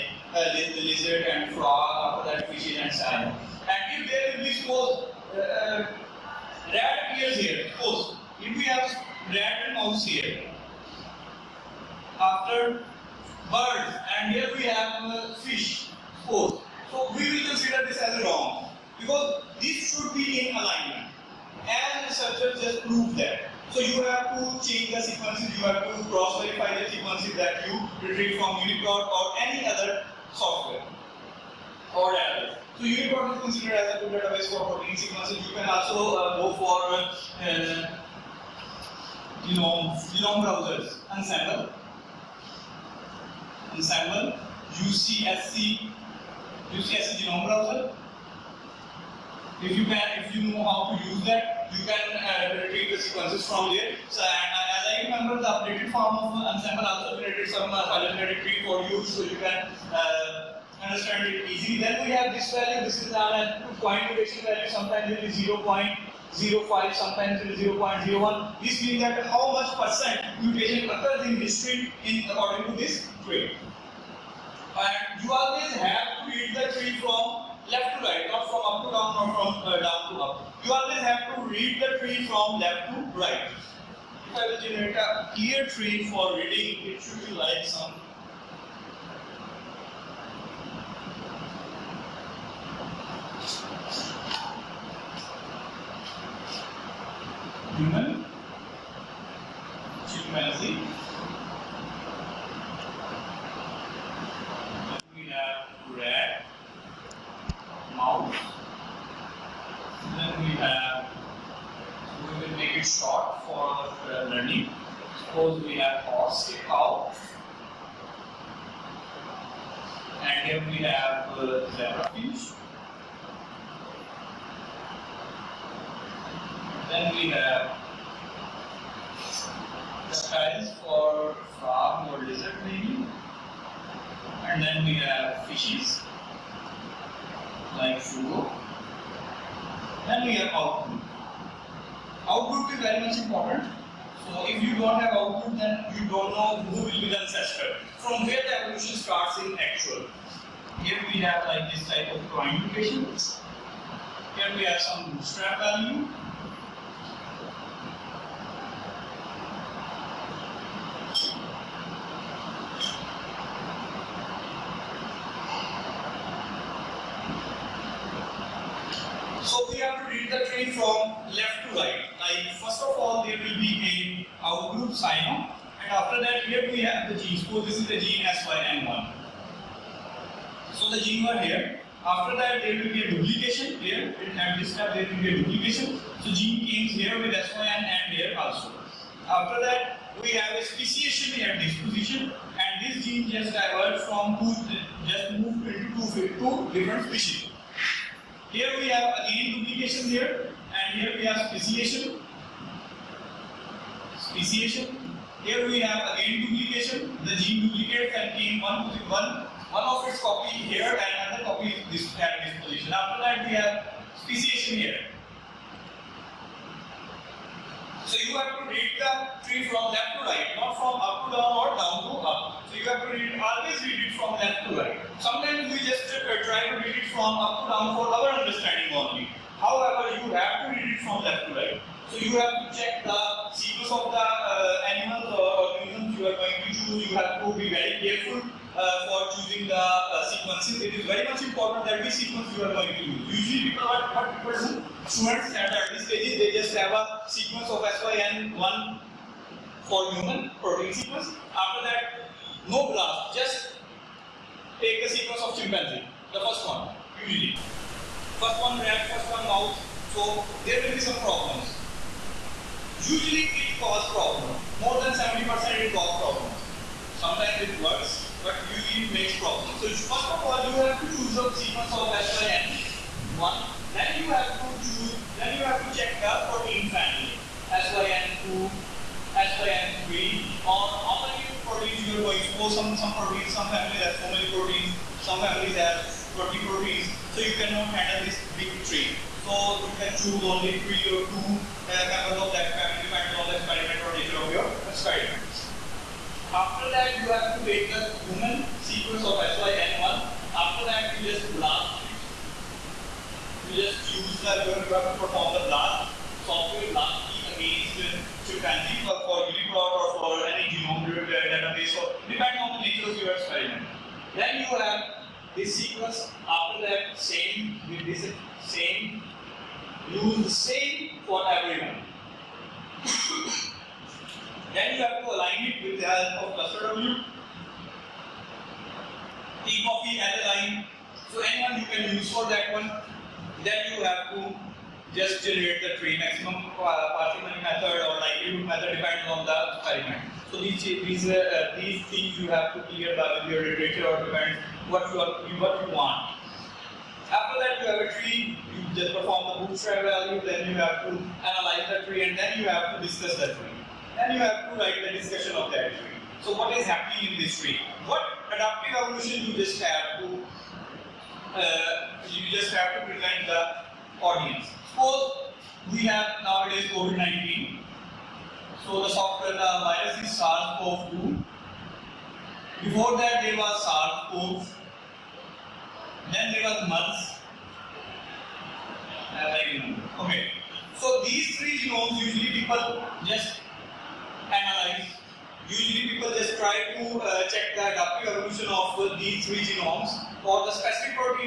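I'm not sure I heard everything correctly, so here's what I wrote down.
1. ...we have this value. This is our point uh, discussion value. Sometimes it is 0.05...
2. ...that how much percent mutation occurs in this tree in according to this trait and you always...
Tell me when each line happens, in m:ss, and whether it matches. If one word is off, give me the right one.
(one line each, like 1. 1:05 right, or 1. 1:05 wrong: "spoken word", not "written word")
1. 1:02 wrong: "mutation", not "discussion"
2. 1:09 right.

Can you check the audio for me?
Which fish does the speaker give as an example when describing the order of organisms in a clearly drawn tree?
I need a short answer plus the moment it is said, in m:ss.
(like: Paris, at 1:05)
Fugu, at 2:17.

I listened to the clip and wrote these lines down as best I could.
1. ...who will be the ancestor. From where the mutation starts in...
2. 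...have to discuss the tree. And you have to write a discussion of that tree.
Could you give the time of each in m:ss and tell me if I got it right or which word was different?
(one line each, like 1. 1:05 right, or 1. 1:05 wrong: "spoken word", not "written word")
1. 2:26 wrong: "evolution", not "mutation"
2. 5:52 right.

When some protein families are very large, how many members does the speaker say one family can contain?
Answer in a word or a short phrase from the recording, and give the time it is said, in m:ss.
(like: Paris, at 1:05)
30, at 4:46.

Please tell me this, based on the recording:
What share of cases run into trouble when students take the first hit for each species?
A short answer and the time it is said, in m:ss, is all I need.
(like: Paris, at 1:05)
More than 70%, at 4:24.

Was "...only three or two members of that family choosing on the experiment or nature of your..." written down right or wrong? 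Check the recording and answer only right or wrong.
wrong.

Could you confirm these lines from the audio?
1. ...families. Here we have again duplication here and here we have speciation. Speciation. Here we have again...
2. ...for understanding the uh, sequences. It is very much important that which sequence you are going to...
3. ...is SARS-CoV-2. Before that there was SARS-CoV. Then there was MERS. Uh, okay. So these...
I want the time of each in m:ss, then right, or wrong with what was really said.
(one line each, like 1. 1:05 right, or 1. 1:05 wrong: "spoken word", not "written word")
1. 3:17 wrong: "species", not "families"
2. 3:59 wrong: "choosing", not "understanding"
3. 6:10 right.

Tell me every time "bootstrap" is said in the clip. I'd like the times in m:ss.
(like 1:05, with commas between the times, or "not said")
5:49.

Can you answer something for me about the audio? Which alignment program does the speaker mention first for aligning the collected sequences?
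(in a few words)
Clustal W.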